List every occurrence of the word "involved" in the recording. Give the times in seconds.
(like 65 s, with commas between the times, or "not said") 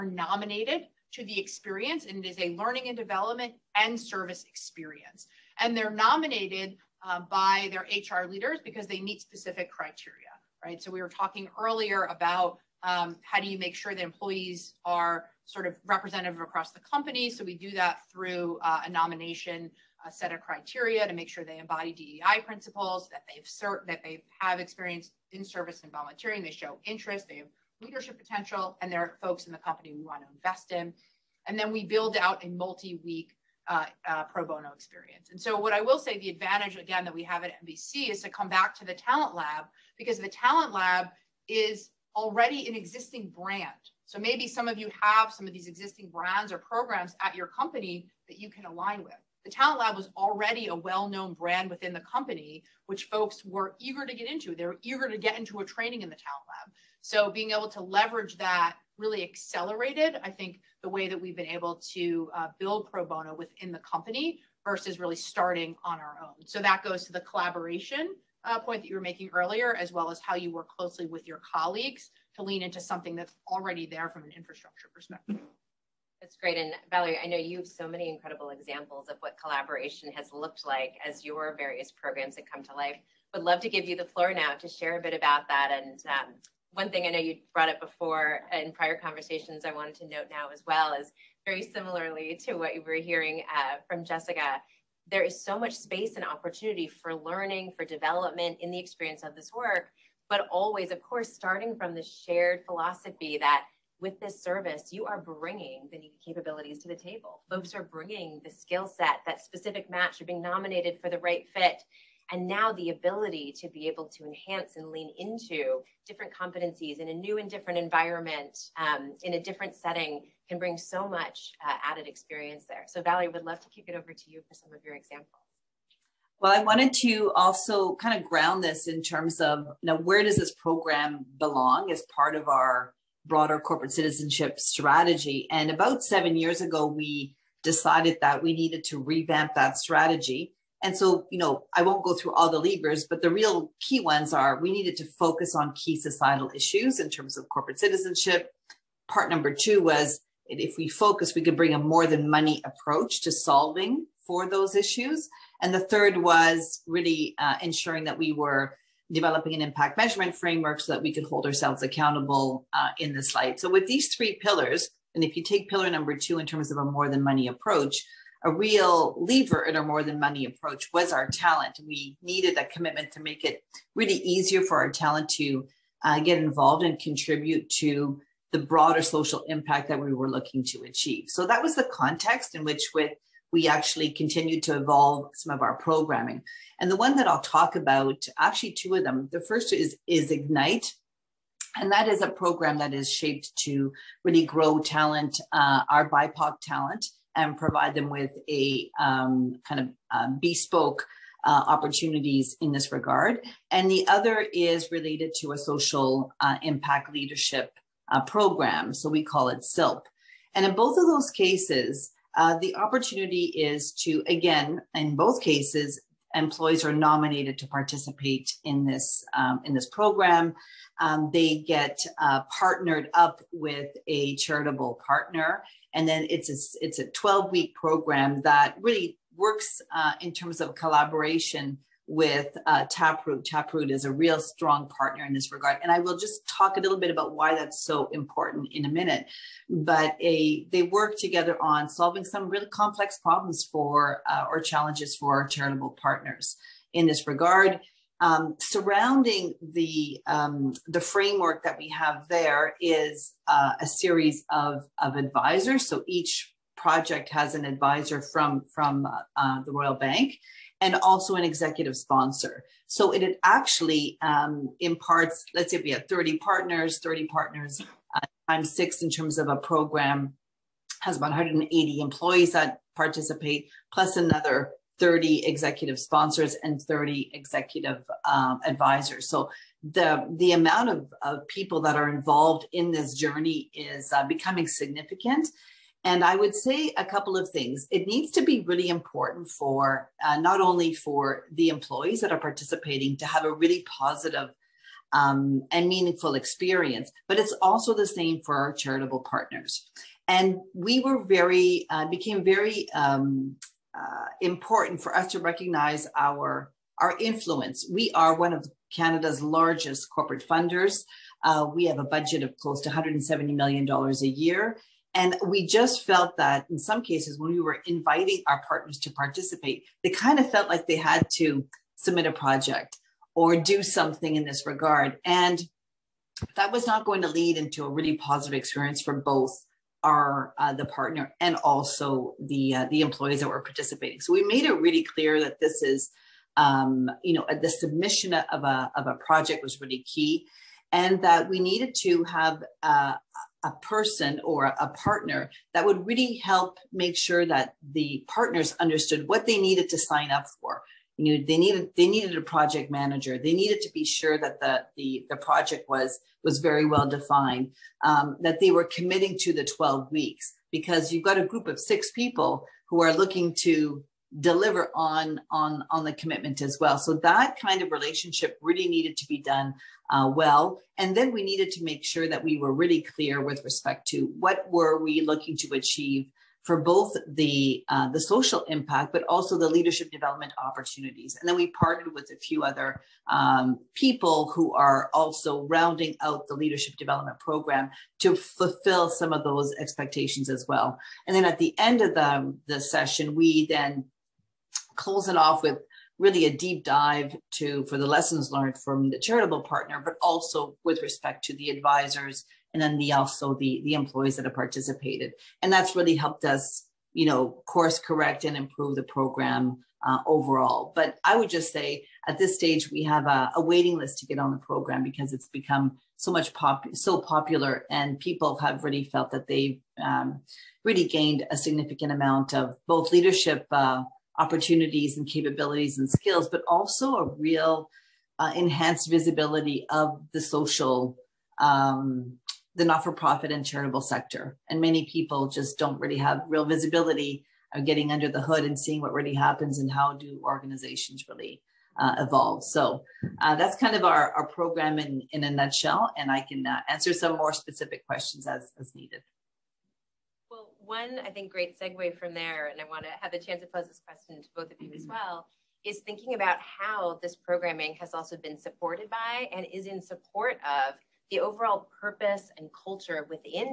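176 s, 282 s.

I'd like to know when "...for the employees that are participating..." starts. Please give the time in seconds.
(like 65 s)
290 s.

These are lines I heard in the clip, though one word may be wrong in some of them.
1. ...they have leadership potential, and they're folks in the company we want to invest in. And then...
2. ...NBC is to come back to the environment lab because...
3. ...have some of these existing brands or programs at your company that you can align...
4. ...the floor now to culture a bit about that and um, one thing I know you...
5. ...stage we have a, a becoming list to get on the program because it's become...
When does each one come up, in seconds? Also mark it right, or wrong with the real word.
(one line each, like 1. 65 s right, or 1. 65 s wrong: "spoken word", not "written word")
1. 27 s right
2. 37 s wrong: "talent", not "environment"
3. 45 s right
4. 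83 s wrong: "share", not "culture"
5. 412 s wrong: "waiting", not "becoming".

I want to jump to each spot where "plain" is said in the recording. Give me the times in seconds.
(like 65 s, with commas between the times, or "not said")
not said.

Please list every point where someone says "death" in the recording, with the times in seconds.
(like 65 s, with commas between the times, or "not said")
not said.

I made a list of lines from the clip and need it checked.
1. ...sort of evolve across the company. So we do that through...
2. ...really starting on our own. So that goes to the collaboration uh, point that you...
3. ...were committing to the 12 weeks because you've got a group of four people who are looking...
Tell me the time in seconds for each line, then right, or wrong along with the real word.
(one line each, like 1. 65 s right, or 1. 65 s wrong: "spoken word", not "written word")
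1. 15 s wrong: "representative", not "evolve"
2. 64 s right
3. 358 s wrong: "six", not "four".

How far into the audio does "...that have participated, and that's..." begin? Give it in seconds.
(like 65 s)
404 s.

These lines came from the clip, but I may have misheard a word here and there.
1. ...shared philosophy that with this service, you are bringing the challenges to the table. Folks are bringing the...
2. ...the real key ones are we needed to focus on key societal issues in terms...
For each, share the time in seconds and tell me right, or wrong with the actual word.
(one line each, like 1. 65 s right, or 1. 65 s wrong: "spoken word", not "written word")
1. 102 s wrong: "capabilities", not "challenges"
2. 143 s right.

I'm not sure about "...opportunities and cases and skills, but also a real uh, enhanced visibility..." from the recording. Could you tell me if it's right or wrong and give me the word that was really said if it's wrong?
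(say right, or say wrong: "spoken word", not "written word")
wrong: "capabilities", not "cases".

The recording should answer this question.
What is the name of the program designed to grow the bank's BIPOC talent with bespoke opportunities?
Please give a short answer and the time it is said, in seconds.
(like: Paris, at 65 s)
Ignite, at 190 s.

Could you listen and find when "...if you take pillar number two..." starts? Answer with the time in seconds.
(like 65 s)
165 s.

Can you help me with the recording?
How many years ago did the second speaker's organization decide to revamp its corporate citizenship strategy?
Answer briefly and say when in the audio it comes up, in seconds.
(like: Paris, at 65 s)
7, at 136 s.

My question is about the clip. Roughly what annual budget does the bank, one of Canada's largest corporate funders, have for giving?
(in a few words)
$170 million.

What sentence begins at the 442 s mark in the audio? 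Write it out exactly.
So uh, that's kind of our, our program in, in a nutshell.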